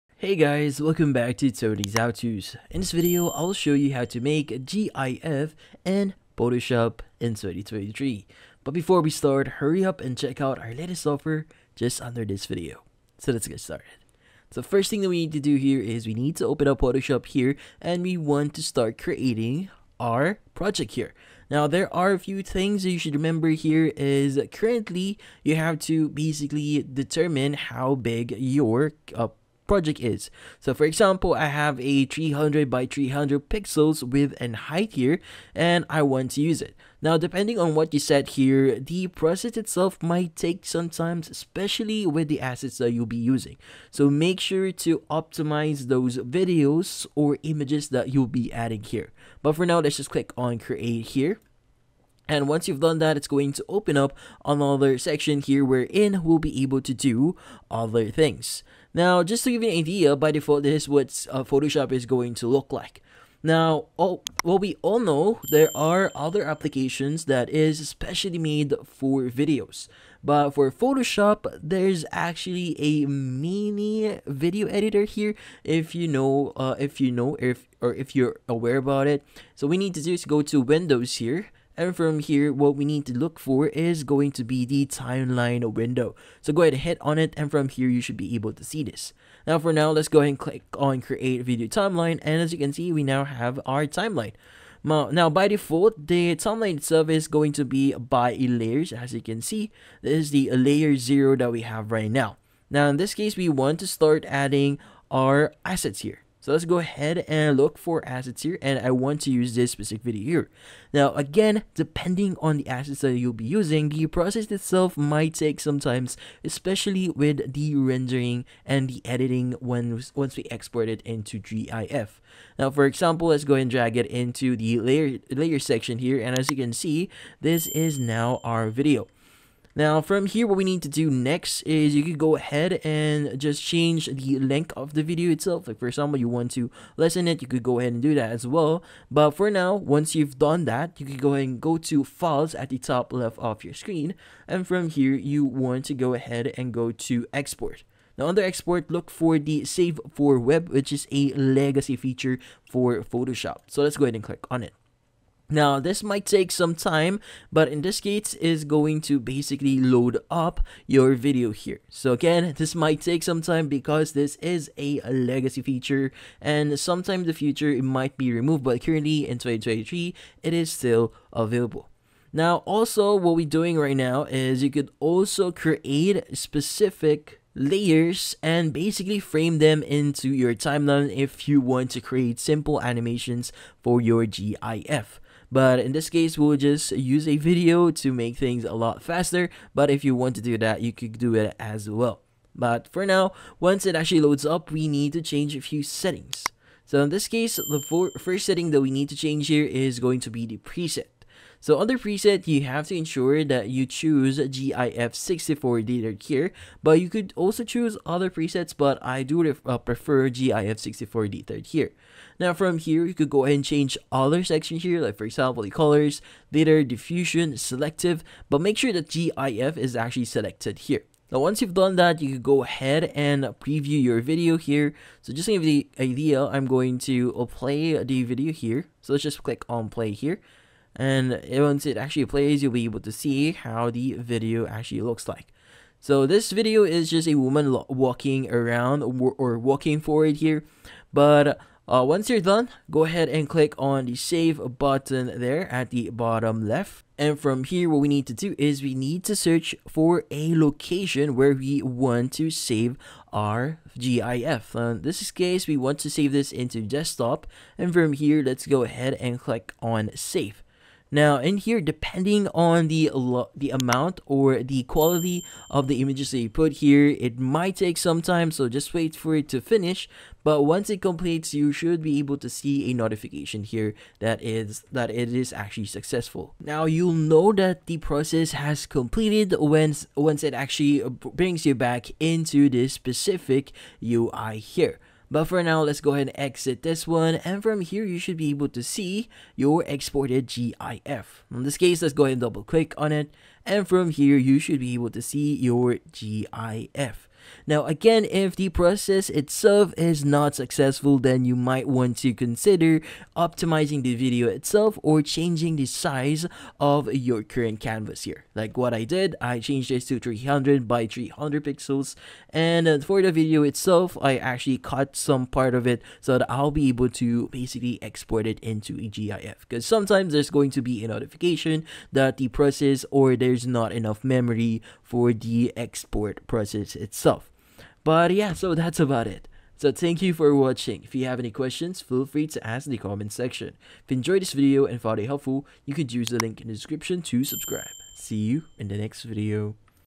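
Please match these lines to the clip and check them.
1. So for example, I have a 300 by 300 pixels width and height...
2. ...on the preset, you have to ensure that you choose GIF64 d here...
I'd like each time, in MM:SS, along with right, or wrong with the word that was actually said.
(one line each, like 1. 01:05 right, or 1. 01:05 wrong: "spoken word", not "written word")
1. 00:30 right
2. 03:21 right.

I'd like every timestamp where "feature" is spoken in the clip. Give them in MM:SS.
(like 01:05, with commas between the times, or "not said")
02:31, 02:45.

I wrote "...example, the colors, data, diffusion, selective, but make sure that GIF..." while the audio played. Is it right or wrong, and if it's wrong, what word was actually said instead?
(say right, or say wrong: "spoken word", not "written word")
right.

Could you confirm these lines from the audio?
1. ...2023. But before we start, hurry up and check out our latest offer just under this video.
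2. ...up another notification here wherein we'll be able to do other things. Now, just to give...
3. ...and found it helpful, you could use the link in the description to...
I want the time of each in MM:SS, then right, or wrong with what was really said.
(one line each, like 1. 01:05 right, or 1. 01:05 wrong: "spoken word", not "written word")
1. 00:07 right
2. 00:53 wrong: "section", not "notification"
3. 05:34 right.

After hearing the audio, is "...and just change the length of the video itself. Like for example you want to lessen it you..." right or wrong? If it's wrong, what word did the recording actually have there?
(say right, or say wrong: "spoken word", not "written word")
right.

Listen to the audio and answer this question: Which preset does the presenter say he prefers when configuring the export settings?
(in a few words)
GIF 64 Dithered.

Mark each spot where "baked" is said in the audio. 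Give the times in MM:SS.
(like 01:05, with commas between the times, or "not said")
not said.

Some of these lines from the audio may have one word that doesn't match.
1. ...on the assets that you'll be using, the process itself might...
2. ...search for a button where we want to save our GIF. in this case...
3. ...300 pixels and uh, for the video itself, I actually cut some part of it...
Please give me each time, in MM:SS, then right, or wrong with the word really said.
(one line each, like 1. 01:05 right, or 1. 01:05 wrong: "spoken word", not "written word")
1. 01:52 right
2. 04:09 wrong: "location", not "button"
3. 05:11 right.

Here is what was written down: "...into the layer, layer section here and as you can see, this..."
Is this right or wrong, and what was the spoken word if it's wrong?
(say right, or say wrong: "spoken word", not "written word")
right.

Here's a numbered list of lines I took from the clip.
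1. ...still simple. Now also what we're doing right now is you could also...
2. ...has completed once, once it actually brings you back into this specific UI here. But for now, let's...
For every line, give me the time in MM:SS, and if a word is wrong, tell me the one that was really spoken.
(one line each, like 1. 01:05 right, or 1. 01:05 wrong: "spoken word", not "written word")
1. 02:50 wrong: "available", not "simple"
2. 04:38 right.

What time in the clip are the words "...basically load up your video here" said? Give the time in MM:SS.
02:39.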